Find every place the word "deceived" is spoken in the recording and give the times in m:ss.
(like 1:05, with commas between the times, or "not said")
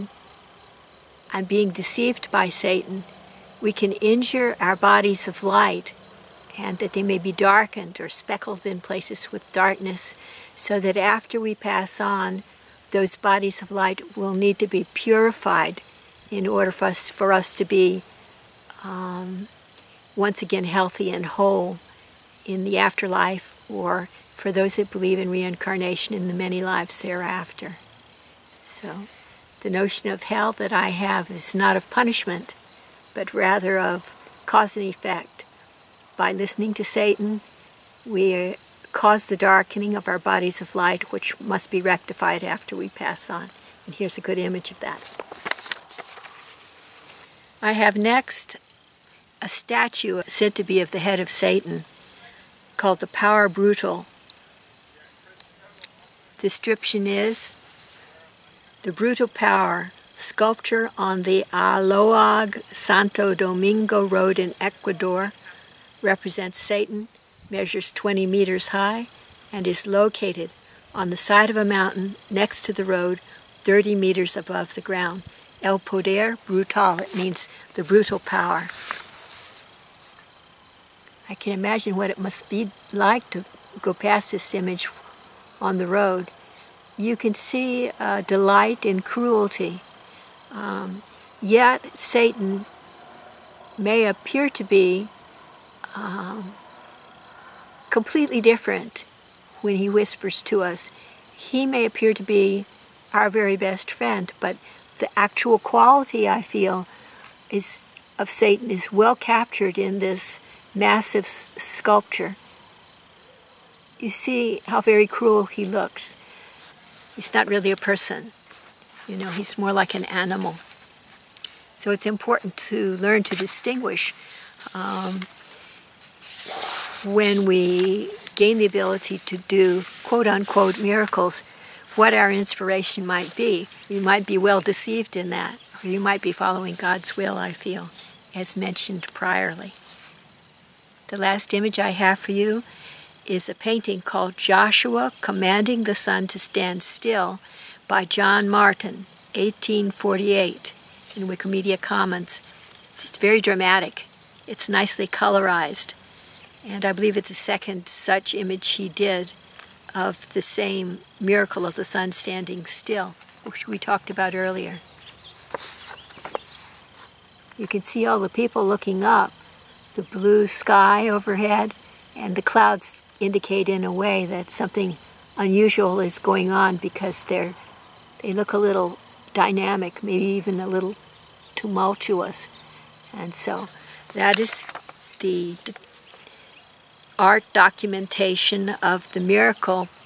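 0:01, 2:14.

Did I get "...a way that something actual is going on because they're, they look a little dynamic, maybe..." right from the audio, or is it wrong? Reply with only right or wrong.
wrong.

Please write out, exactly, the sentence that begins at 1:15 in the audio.
El poder brutal, it means the brutal power.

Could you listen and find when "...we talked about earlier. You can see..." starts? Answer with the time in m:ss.
2:43.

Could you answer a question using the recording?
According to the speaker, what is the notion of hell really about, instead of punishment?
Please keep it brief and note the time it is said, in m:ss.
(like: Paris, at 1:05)
Cause and effect, at 0:34.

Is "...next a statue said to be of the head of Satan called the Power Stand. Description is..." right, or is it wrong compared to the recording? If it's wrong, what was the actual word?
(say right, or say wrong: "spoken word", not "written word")
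wrong: "Brutal", not "Stand".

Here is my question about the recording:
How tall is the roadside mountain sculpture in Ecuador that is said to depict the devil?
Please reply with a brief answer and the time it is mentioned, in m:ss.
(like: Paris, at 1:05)
20 meters, at 1:07.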